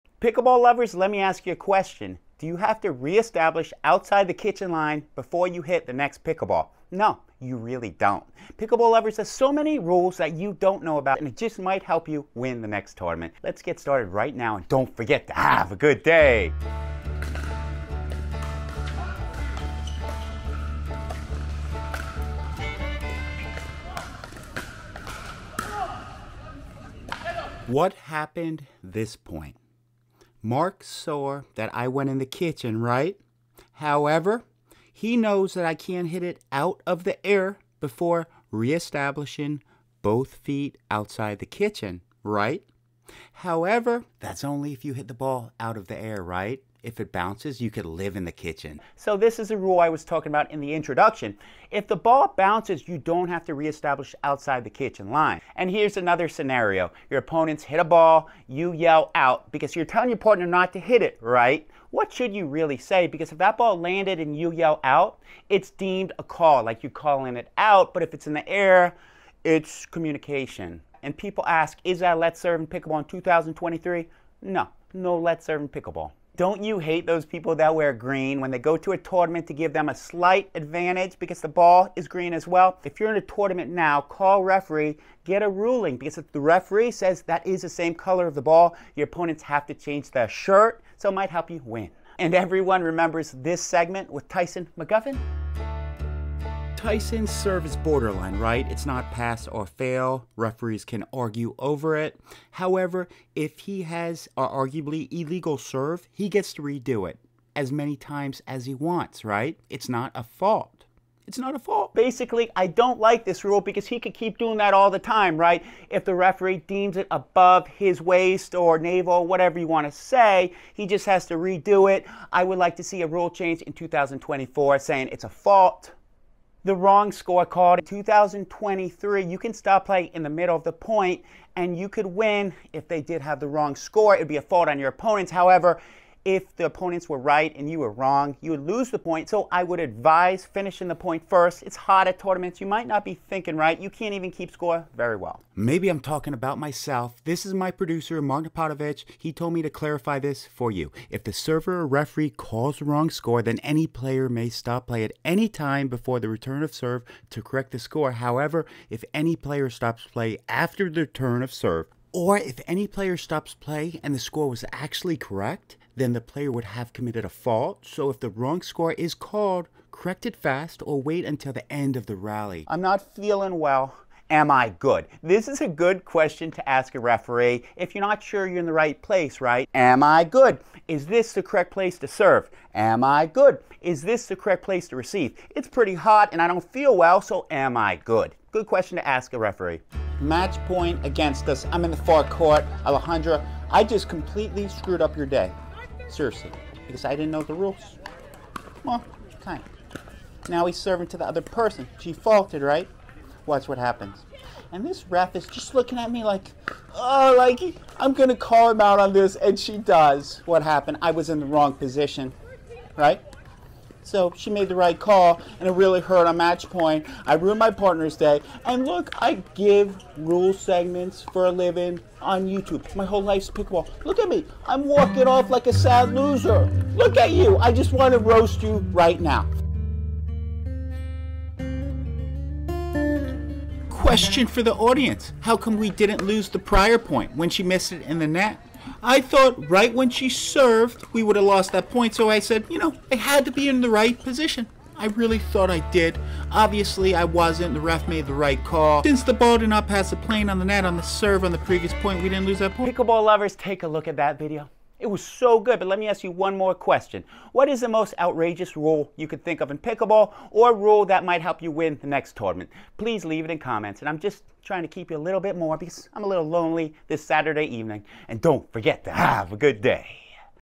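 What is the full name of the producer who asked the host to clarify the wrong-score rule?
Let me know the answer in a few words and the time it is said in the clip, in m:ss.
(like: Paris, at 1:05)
Mark Potovich, at 2:28.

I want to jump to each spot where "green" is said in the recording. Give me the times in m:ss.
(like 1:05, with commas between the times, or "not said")
1:17, 1:22.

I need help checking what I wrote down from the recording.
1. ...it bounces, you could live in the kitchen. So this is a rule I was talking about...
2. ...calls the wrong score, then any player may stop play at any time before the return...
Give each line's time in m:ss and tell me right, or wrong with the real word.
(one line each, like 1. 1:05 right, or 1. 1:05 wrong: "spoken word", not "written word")
1. 0:46 right
2. 2:32 right.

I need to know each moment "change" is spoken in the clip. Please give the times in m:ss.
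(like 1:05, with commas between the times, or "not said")
1:29, 2:03.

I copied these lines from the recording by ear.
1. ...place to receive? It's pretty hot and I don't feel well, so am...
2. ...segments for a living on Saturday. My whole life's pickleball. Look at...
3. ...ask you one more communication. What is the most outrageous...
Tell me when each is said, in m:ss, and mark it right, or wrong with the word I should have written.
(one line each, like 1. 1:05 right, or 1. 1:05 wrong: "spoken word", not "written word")
1. 3:04 right
2. 3:40 wrong: "YouTube", not "Saturday"
3. 4:16 wrong: "question", not "communication".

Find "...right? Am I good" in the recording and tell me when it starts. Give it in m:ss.
2:59.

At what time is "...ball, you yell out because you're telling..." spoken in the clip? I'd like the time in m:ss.
0:57.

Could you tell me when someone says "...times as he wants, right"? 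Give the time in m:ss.
1:47.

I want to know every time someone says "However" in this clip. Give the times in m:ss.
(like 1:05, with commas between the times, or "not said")
0:33, 0:43, 1:42, 2:15, 2:38.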